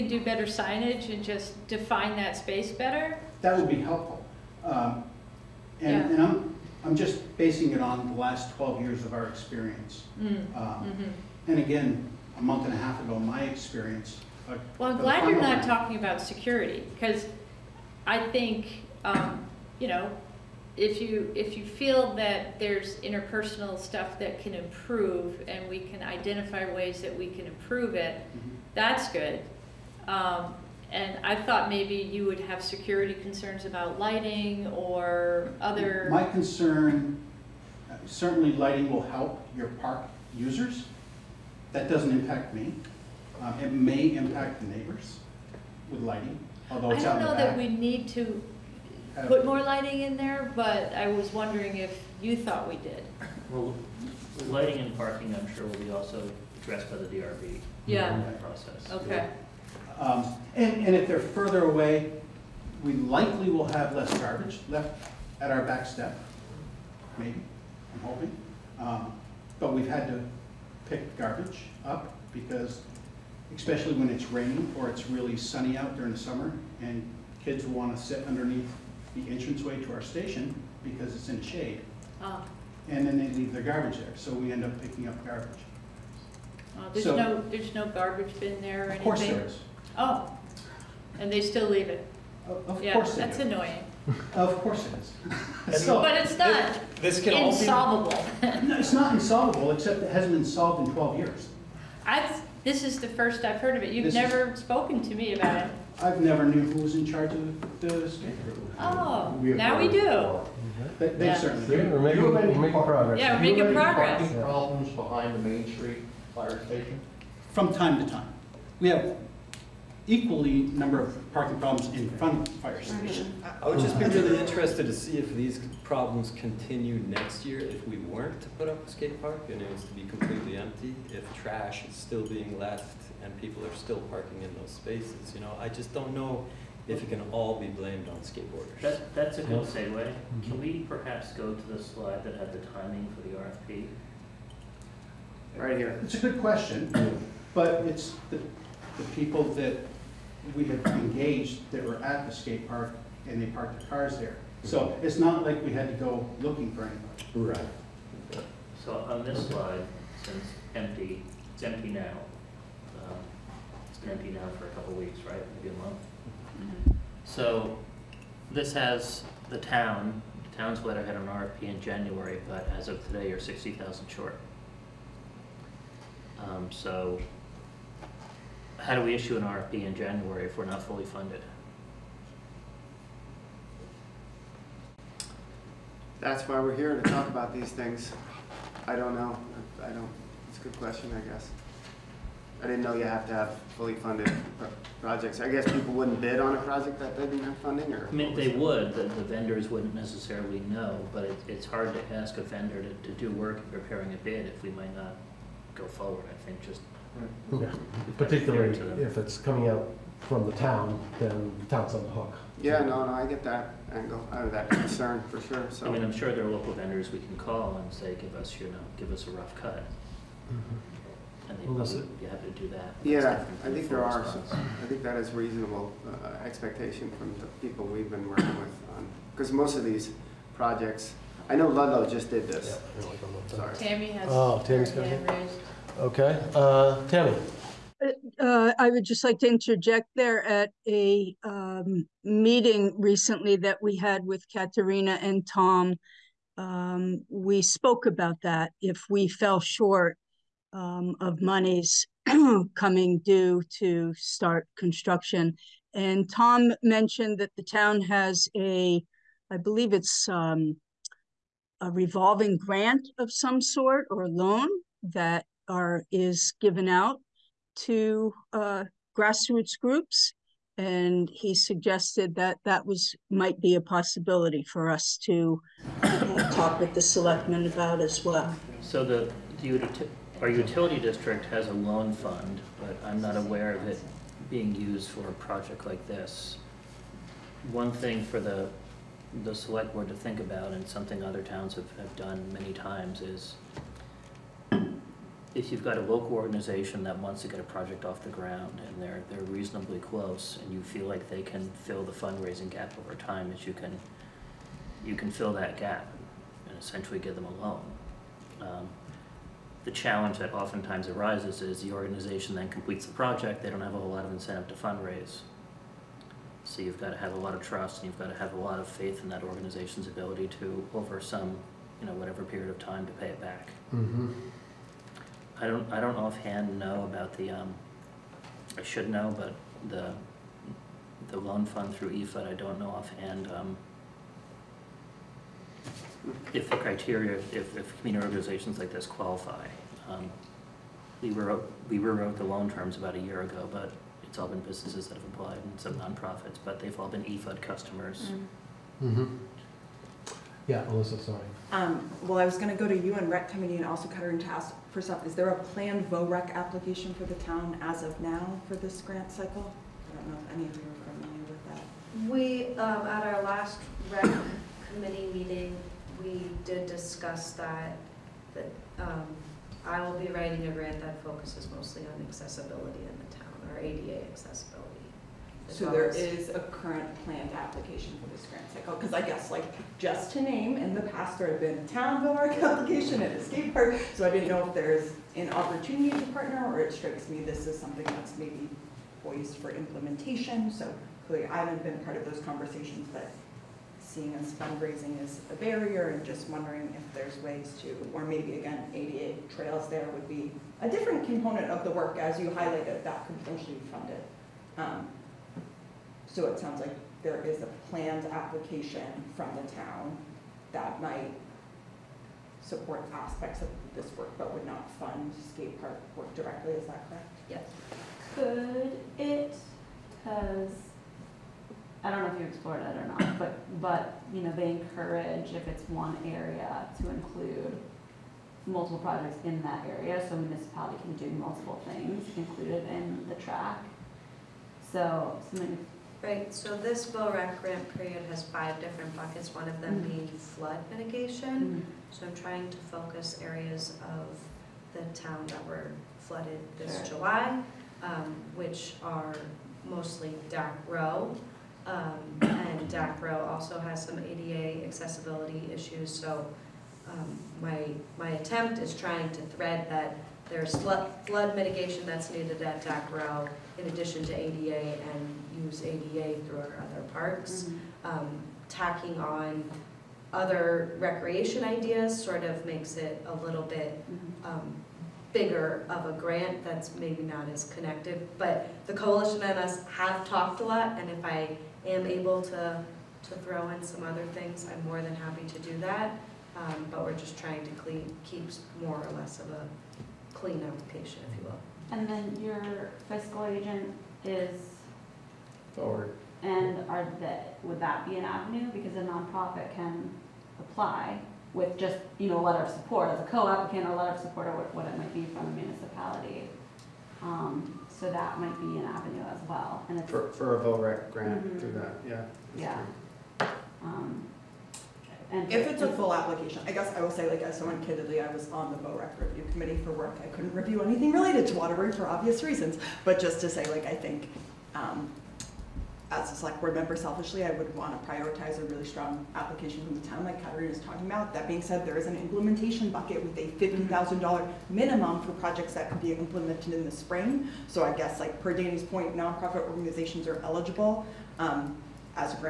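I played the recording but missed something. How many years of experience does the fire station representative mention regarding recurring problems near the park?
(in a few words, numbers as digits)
12 years.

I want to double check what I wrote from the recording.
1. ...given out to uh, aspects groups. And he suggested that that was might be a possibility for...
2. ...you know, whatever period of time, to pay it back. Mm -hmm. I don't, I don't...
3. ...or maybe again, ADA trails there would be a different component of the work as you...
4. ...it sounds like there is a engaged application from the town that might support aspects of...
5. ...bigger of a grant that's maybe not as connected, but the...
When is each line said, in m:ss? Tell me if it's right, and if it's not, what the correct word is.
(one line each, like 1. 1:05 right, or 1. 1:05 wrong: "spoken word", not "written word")
1. 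4:26 wrong: "grassroots", not "aspects"
2. 5:22 right
3. 6:38 right
4. 6:46 wrong: "planned", not "engaged"
5. 7:55 right.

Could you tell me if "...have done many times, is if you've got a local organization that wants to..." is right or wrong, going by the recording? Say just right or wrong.
right.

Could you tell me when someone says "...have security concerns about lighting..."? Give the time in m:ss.
0:32.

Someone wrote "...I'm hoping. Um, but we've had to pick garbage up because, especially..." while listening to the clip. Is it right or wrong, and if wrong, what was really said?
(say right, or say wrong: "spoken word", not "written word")
right.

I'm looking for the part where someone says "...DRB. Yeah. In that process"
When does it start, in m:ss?
0:57.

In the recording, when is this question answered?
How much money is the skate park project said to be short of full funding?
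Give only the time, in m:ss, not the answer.
2:53.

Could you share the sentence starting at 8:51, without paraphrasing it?
That being said, there is an implementation bucket with a 50000 dollars minimum for projects that could be implemented in the spring.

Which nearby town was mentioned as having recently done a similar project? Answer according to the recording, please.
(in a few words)
Ludlow.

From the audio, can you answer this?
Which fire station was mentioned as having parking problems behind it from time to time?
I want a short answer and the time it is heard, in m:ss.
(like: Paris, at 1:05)
Main Street fire station, at 1:55.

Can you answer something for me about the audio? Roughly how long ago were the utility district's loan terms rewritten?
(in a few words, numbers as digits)
about a year ago.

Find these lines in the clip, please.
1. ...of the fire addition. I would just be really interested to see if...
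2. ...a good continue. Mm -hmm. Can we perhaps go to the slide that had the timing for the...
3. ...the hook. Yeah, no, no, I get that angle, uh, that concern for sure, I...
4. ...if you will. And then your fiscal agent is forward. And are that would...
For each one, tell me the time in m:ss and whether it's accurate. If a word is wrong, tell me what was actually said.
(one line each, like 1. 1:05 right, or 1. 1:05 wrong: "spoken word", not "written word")
1. 2:02 wrong: "station", not "addition"
2. 2:19 wrong: "segue", not "continue"
3. 3:32 right
4. 8:11 right.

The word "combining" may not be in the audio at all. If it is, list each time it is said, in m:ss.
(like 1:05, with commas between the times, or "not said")
not said.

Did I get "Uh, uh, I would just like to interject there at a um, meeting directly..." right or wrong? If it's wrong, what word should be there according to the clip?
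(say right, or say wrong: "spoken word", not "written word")
wrong: "recently", not "directly".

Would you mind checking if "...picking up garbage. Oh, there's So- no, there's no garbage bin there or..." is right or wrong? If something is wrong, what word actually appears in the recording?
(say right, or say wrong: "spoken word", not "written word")
right.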